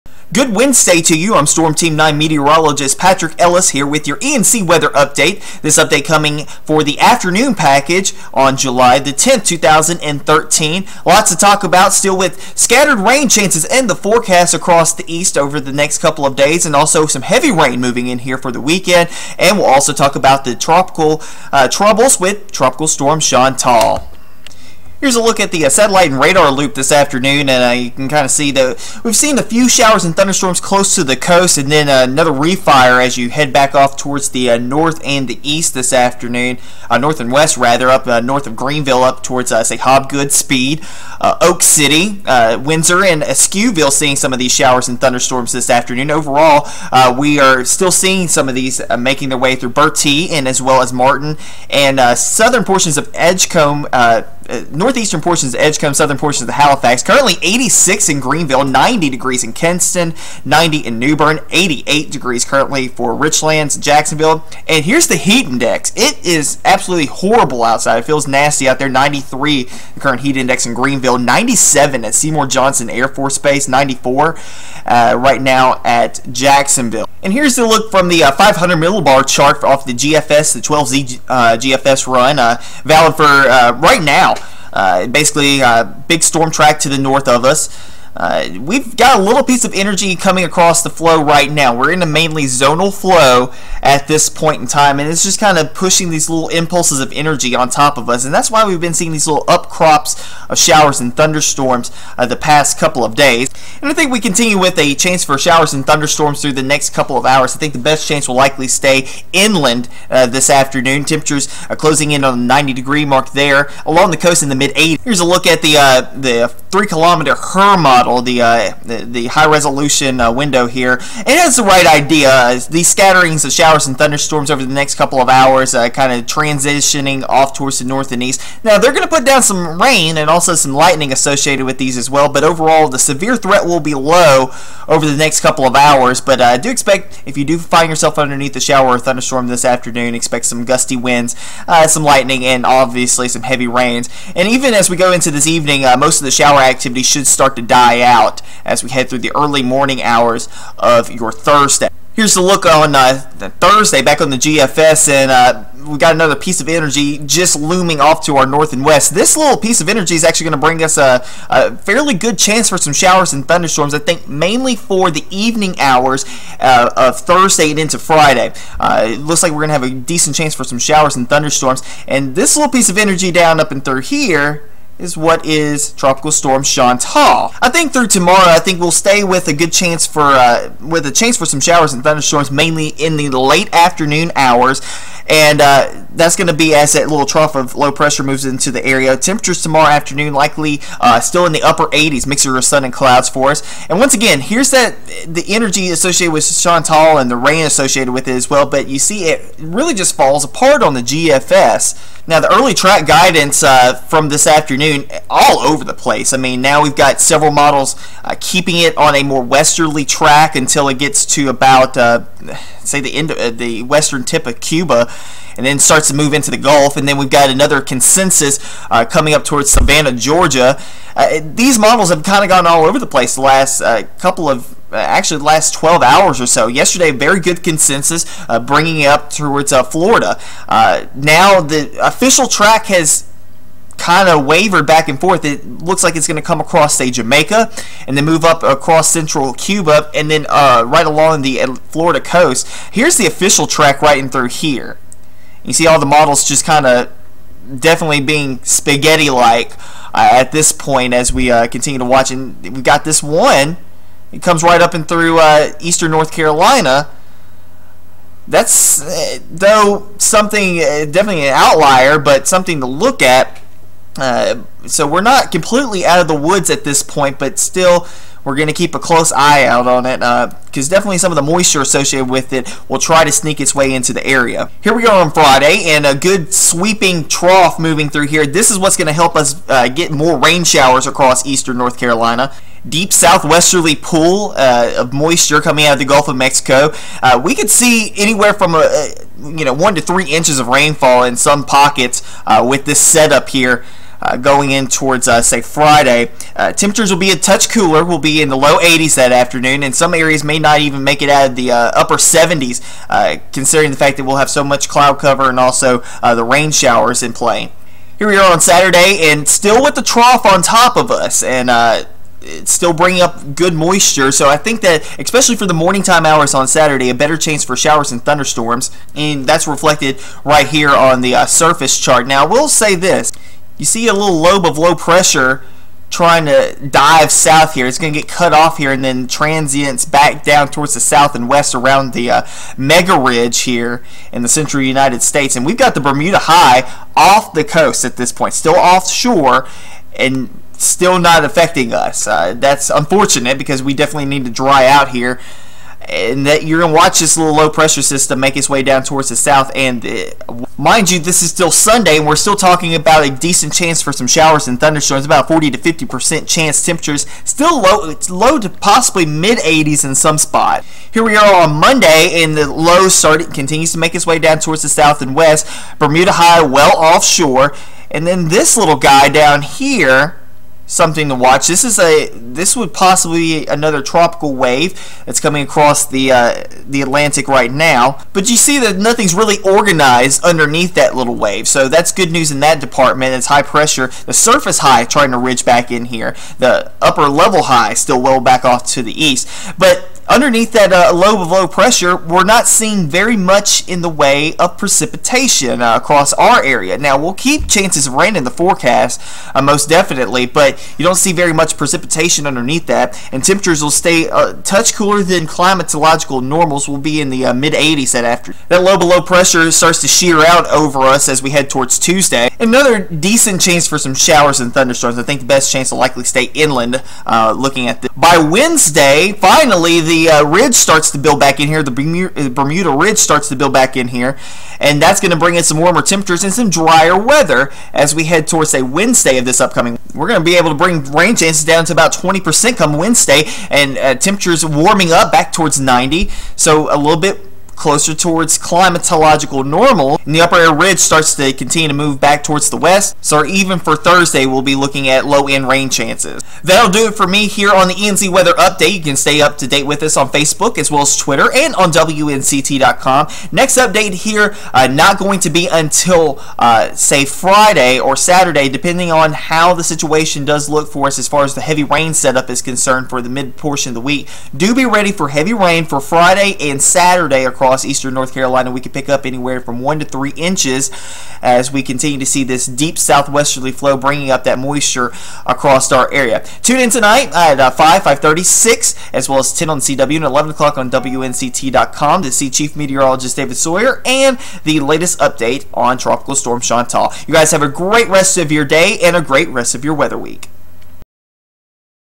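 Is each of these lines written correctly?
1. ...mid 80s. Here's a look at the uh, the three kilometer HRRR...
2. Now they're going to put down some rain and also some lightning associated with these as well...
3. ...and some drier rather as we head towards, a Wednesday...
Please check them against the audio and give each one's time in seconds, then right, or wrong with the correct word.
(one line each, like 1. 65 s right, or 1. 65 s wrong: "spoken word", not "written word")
1. 114 s right
2. 128 s right
3. 426 s wrong: "weather", not "rather".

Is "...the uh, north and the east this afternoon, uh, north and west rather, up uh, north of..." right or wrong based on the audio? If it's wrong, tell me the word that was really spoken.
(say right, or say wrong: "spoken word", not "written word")
right.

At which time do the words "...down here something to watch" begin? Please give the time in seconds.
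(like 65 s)
369 s.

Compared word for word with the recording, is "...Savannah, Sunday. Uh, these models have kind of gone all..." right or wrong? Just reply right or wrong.
wrong.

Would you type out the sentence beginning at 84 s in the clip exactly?
Uh, basically, a uh, big storm track to the north of us.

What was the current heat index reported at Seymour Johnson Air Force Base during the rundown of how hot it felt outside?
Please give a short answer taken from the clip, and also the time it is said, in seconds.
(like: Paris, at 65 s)
97, at 71 s.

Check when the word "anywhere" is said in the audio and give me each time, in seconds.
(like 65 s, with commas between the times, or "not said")
288 s, 469 s.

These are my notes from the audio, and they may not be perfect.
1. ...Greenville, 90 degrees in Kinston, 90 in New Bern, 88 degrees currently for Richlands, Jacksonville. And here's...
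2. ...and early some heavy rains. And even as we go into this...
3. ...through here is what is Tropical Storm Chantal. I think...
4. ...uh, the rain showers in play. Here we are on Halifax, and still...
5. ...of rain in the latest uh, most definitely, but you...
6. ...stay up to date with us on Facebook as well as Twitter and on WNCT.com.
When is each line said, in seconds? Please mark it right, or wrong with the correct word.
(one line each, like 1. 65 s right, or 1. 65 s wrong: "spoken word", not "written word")
1. 58 s right
2. 142 s wrong: "obviously", not "early"
3. 173 s right
4. 306 s wrong: "Saturday", not "Halifax"
5. 398 s wrong: "forecast", not "latest"
6. 449 s right.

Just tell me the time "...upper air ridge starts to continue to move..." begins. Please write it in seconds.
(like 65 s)
440 s.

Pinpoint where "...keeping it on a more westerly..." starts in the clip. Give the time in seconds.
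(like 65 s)
208 s.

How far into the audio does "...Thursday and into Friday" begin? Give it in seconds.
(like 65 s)
167 s.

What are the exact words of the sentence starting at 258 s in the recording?
That's, uh, though, something, uh, definitely an outlier, but something to look at.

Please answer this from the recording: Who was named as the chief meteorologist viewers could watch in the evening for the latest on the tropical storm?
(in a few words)
David Sawyer.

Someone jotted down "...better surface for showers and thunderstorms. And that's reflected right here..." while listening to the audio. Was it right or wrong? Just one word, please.
wrong.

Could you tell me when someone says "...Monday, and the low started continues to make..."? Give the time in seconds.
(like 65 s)
361 s.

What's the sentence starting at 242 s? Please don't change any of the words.
Here's the official track right in through here.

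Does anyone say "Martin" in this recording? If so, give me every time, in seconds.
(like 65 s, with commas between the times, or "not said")
50 s.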